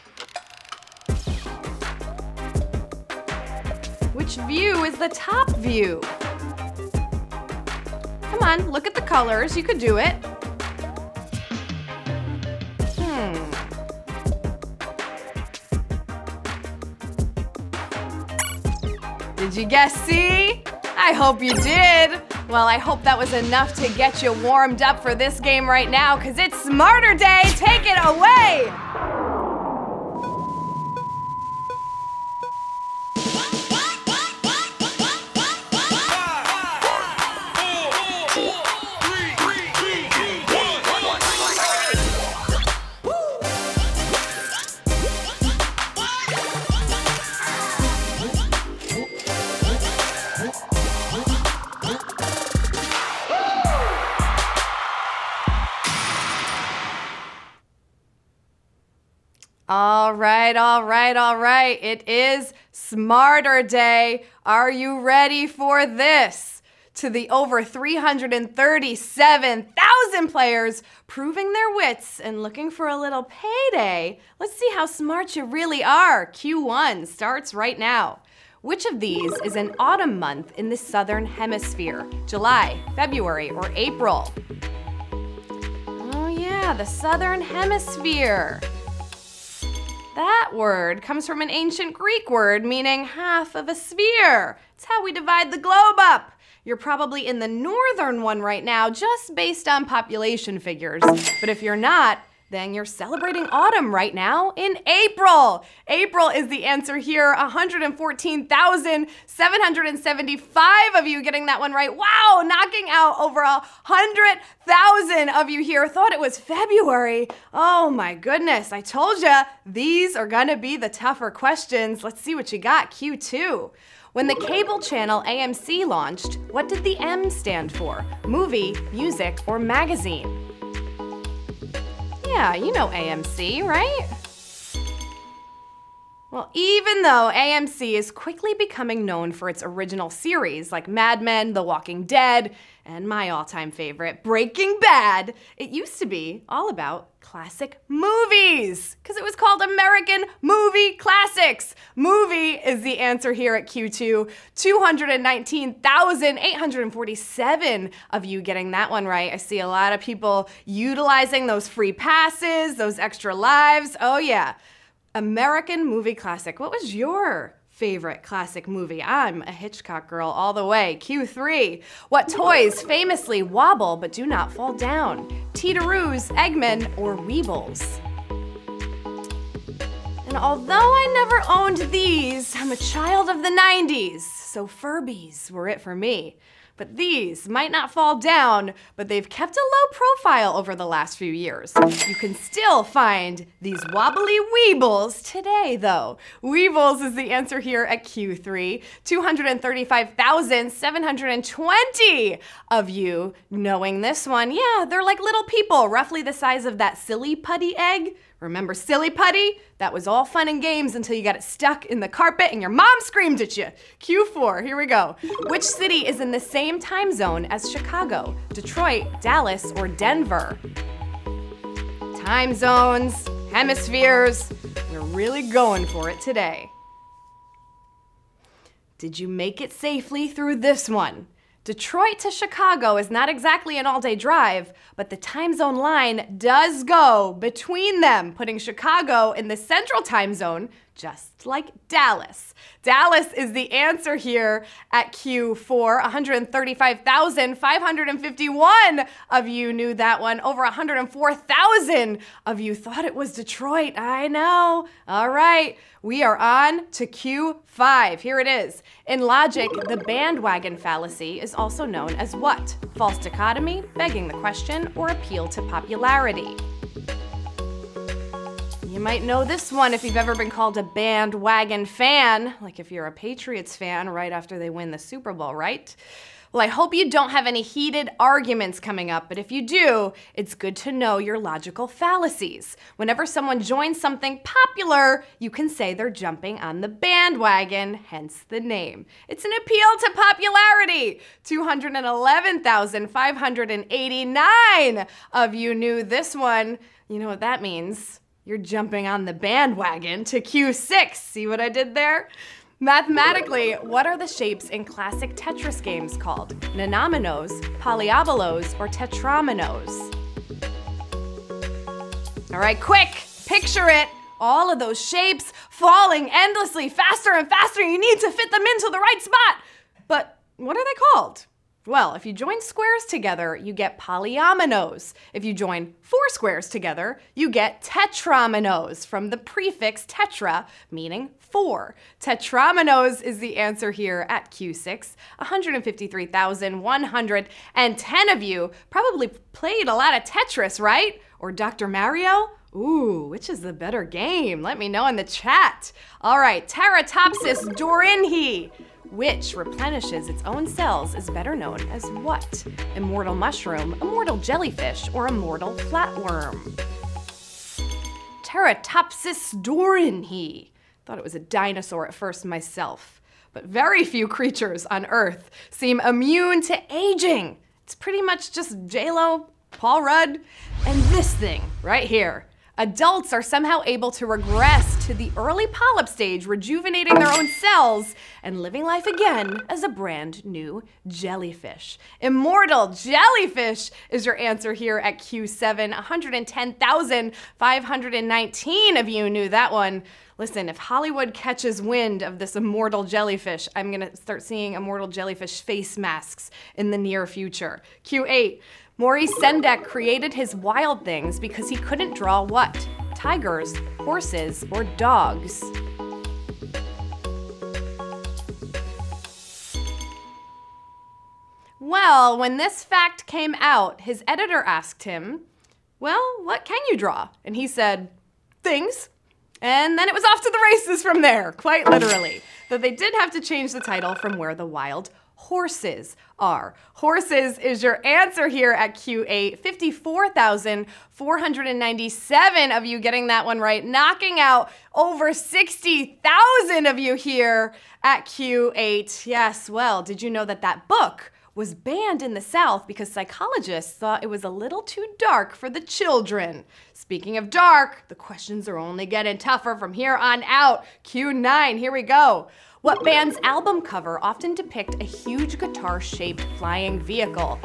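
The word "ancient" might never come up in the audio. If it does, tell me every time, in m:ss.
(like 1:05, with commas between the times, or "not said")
1:31.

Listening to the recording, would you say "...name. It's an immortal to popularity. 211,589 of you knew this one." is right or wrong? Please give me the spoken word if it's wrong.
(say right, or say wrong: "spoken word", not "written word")
wrong: "appeal", not "immortal".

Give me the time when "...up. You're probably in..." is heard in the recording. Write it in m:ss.
1:35.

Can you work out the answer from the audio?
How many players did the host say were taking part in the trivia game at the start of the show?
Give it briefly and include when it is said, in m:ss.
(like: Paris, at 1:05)
337,000, at 1:07.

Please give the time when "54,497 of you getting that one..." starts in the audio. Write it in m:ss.
7:09.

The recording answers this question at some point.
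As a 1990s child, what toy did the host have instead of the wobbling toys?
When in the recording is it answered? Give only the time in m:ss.
3:04.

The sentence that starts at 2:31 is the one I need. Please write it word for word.
Movie is the answer here at Q2.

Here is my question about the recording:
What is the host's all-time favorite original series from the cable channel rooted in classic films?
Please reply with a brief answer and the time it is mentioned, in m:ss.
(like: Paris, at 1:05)
Breaking Bad, at 2:24.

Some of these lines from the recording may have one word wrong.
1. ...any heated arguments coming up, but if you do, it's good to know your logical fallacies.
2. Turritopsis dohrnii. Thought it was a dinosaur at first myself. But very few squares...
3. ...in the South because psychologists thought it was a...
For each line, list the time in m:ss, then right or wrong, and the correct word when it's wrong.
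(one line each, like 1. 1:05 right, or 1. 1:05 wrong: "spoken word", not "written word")
1. 4:37 right
2. 5:58 wrong: "creatures", not "squares"
3. 7:22 right.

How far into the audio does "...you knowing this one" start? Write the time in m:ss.
3:22.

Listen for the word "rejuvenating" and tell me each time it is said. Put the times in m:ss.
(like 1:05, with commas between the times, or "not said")
6:16.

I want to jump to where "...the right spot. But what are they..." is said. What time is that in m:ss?
5:18.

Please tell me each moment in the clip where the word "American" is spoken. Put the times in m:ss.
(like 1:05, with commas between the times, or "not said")
2:29, 2:45.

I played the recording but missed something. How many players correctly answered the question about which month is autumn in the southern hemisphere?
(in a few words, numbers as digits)
114,775.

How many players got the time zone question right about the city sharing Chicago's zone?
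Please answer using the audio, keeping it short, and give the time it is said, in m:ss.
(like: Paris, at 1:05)
135,551, at 4:06.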